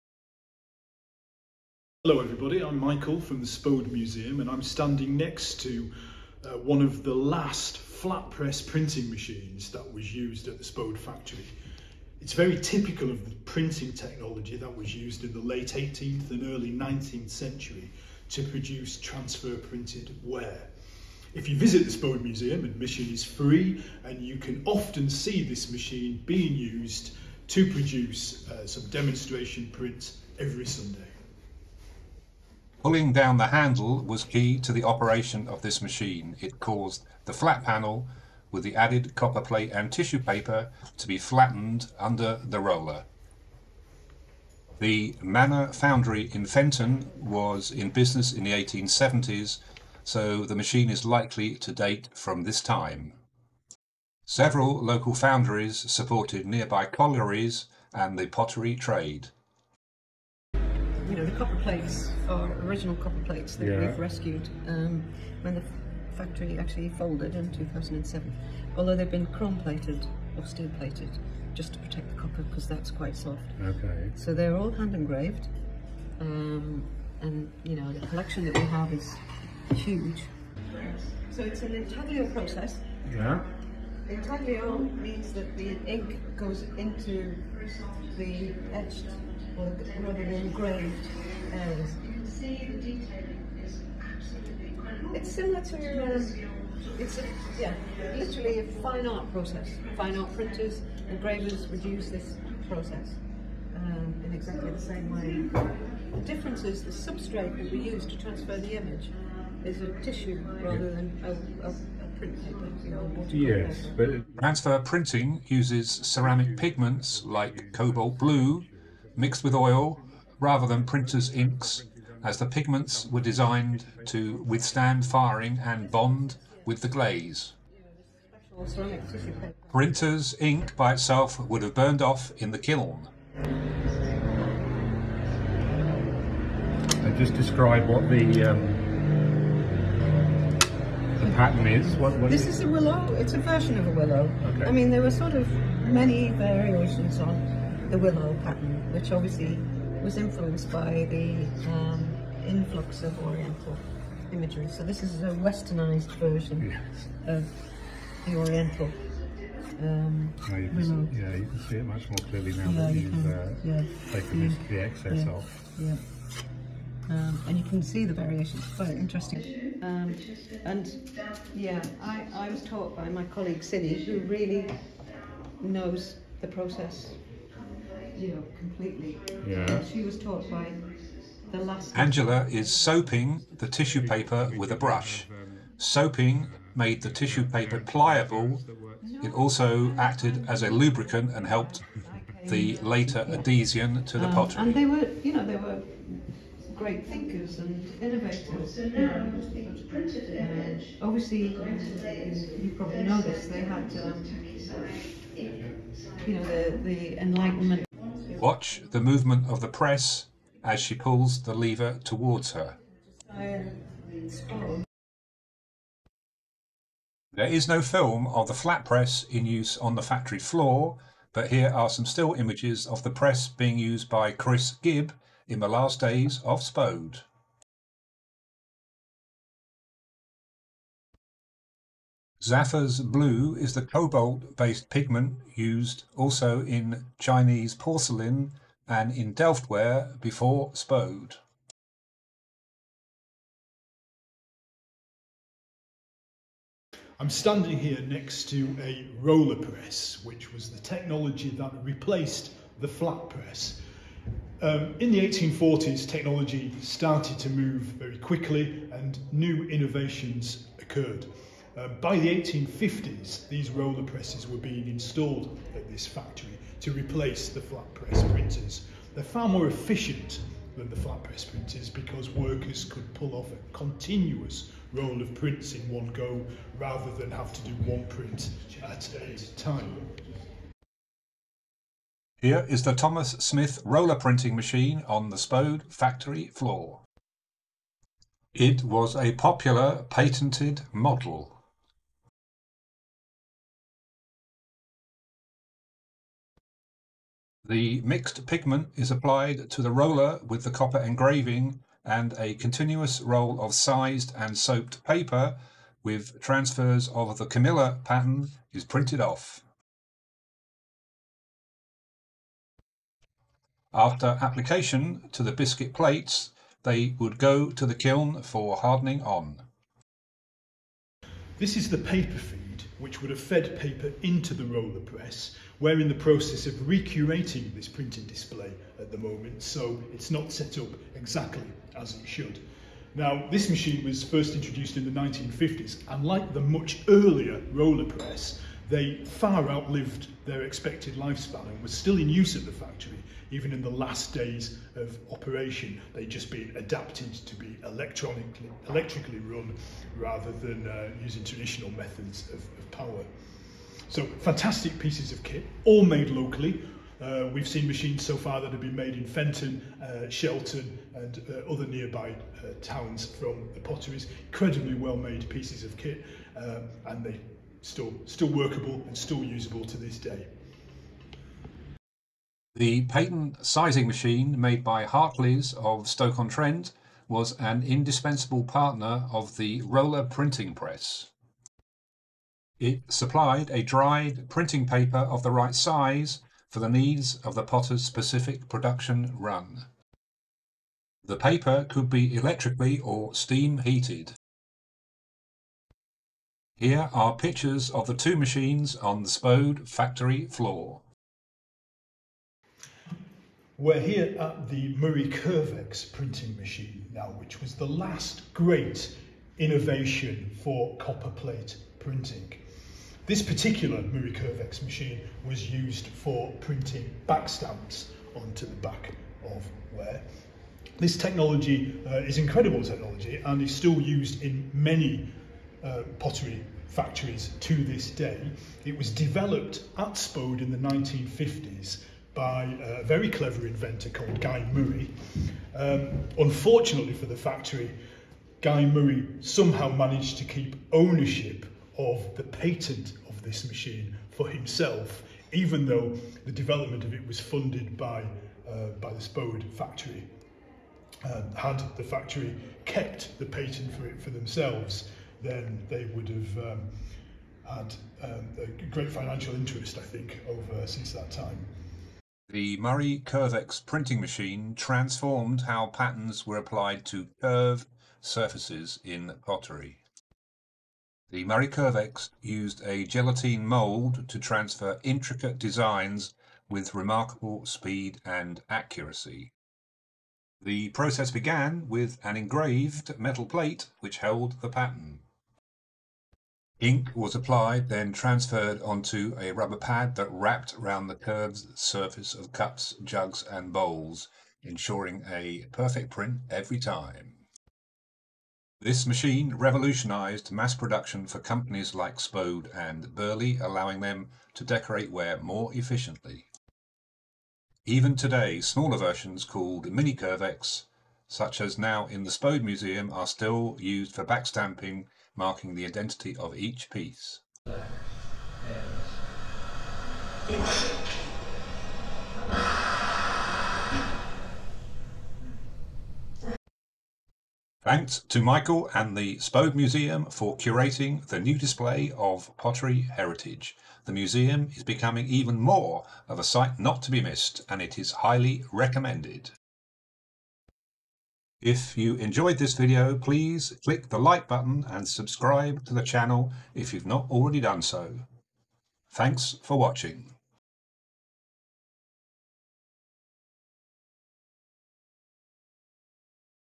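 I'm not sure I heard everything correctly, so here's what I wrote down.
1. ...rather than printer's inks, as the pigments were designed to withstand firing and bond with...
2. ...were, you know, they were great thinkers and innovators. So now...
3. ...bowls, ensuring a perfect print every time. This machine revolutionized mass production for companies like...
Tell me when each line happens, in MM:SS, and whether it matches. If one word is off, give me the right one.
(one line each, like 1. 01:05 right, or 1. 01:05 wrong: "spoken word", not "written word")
1. 02:00 right
2. 03:14 right
3. 08:13 right.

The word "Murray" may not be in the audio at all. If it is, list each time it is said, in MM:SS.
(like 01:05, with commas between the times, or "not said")
06:44, 06:54, 07:14, 07:18, 07:42, 07:51.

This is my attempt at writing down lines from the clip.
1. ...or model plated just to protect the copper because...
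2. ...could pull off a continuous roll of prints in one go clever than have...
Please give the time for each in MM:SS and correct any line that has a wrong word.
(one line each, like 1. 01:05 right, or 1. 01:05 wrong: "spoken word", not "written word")
1. 01:10 wrong: "steel", not "model"
2. 04:32 wrong: "rather", not "clever".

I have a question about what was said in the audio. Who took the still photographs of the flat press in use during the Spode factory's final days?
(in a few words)
Chris Gibb.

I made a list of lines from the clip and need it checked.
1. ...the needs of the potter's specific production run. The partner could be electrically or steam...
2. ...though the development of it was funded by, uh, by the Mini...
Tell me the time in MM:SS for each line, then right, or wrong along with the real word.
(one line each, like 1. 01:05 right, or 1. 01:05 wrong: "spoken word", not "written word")
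1. 06:26 wrong: "paper", not "partner"
2. 07:25 wrong: "Spode", not "Mini".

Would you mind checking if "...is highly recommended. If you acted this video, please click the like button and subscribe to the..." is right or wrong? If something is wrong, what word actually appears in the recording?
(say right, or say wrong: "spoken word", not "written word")
wrong: "enjoyed", not "acted".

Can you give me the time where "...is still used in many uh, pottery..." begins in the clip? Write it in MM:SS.
07:03.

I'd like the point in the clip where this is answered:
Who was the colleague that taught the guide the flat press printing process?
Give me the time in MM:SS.
02:53.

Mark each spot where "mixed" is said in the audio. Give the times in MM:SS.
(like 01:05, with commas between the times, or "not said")
01:59, 04:58.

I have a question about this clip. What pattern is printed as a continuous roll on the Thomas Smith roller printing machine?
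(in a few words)
Camilla.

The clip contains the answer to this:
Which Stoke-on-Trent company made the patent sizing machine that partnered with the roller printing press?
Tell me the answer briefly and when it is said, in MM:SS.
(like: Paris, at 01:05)
Hartley's, at 06:15.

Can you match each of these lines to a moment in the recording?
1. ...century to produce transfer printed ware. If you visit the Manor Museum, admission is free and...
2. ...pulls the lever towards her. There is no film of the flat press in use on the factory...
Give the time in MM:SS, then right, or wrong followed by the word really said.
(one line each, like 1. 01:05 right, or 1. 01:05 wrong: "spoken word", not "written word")
1. 00:17 wrong: "Spode", not "Manor"
2. 03:30 right.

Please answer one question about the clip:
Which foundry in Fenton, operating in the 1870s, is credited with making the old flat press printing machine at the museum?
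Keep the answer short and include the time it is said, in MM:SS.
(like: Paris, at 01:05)
Manor Foundry, at 00:44.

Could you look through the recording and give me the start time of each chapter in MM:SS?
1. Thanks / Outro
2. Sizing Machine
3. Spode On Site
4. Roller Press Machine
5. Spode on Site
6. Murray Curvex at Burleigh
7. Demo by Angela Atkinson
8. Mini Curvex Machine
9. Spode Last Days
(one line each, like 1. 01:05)
1. 08:53
2. 05:27
3. 06:19
4. 04:13
5. 04:46
6. 07:48
7. 01:01
8. 06:49
9. 03:39.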